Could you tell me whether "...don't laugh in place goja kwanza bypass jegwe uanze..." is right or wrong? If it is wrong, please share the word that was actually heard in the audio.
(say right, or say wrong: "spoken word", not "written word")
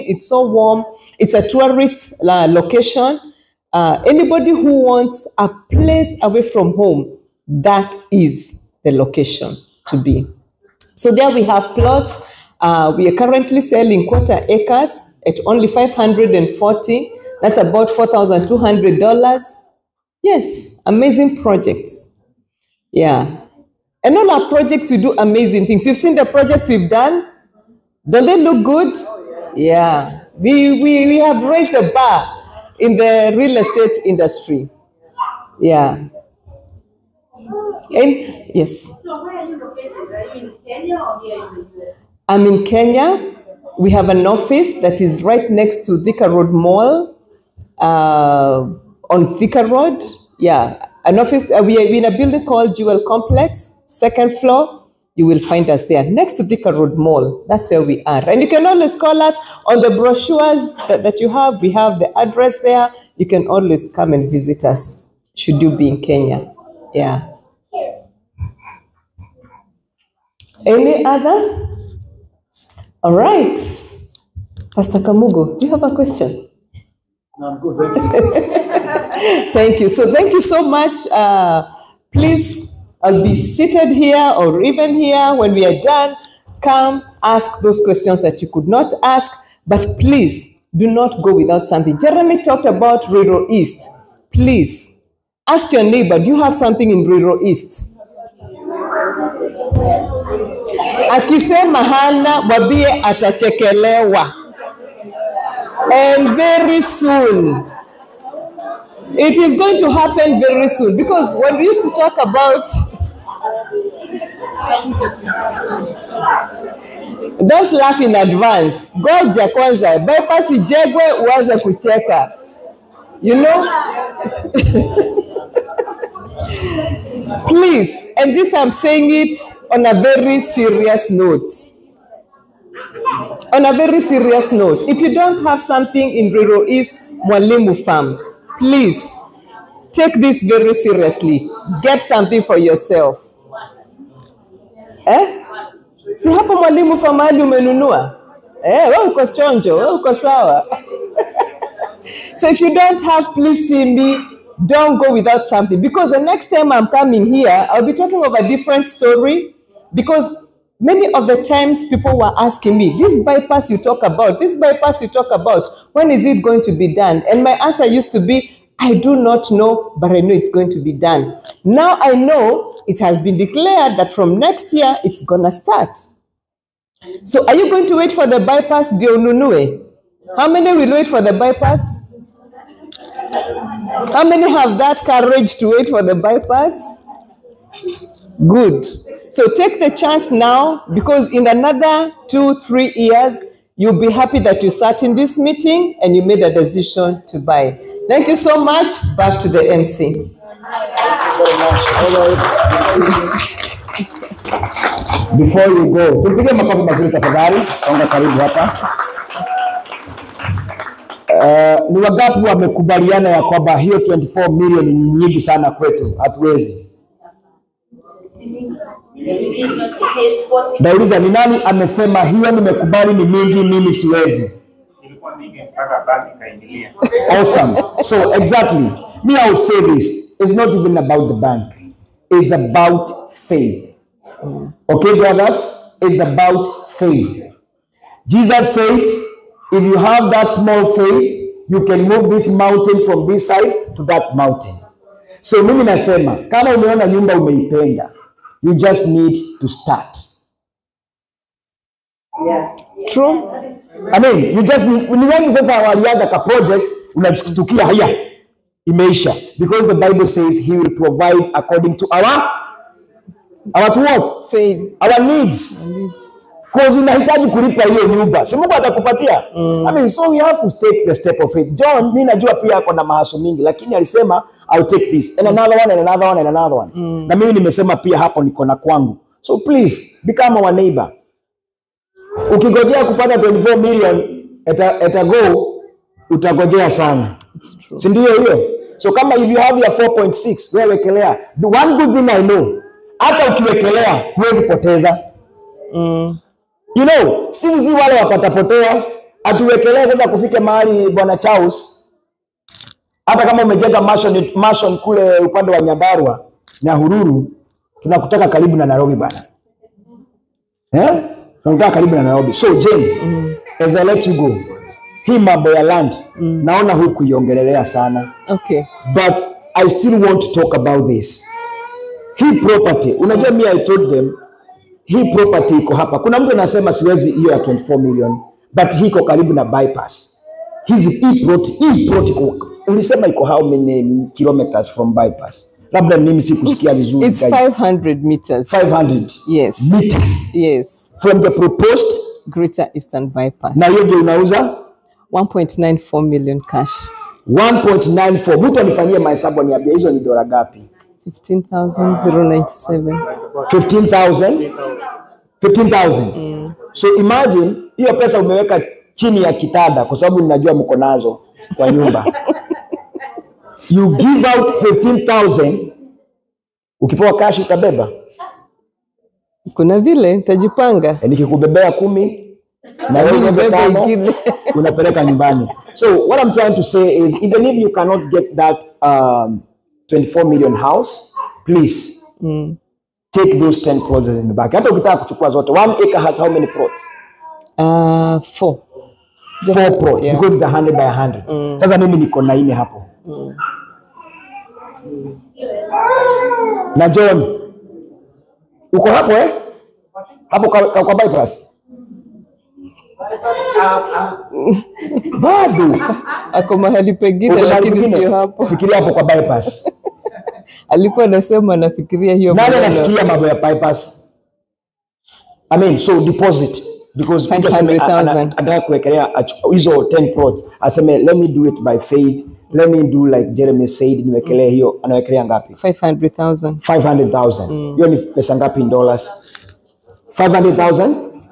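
wrong: "advance", not "place".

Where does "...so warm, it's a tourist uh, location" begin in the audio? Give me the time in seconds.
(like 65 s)
0 s.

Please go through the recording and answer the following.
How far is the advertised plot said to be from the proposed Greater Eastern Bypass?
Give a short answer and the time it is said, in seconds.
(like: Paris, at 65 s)
500 meters, at 337 s.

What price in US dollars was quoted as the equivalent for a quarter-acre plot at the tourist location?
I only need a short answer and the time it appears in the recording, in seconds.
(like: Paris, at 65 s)
$4,200, at 17 s.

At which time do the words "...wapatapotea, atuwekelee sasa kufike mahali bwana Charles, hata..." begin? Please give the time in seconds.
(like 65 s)
298 s.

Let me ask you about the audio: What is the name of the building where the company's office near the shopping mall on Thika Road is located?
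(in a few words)
Jewel Complex.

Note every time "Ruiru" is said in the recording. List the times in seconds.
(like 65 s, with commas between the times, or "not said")
93 s, 97 s, 136 s.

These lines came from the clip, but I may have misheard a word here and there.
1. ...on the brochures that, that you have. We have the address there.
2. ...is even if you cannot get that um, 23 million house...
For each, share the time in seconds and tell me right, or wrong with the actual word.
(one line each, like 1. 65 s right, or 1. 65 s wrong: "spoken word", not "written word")
1. 59 s right
2. 377 s wrong: "24", not "23".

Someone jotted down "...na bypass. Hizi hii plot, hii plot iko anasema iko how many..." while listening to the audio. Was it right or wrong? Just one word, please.
wrong.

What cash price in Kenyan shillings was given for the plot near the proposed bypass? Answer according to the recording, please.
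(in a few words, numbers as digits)
1.94 million.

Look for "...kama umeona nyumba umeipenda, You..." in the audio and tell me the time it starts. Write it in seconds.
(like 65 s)
246 s.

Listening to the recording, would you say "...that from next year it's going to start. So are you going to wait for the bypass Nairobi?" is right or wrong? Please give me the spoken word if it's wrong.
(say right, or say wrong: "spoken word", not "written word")
wrong: "Dionunue", not "Nairobi".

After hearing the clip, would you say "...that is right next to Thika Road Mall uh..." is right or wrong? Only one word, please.
right.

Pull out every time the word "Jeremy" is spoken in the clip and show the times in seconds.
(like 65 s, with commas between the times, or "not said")
91 s, 423 s.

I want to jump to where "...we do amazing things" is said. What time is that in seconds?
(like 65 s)
24 s.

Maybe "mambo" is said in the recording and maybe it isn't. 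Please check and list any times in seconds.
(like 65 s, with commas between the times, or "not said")
315 s, 413 s.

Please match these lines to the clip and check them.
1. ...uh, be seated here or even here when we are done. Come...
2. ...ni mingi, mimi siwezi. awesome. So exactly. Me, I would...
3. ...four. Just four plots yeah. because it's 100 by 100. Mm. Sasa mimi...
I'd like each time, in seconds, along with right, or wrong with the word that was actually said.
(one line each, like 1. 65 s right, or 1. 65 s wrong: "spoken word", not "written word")
1. 83 s right
2. 223 s right
3. 388 s right.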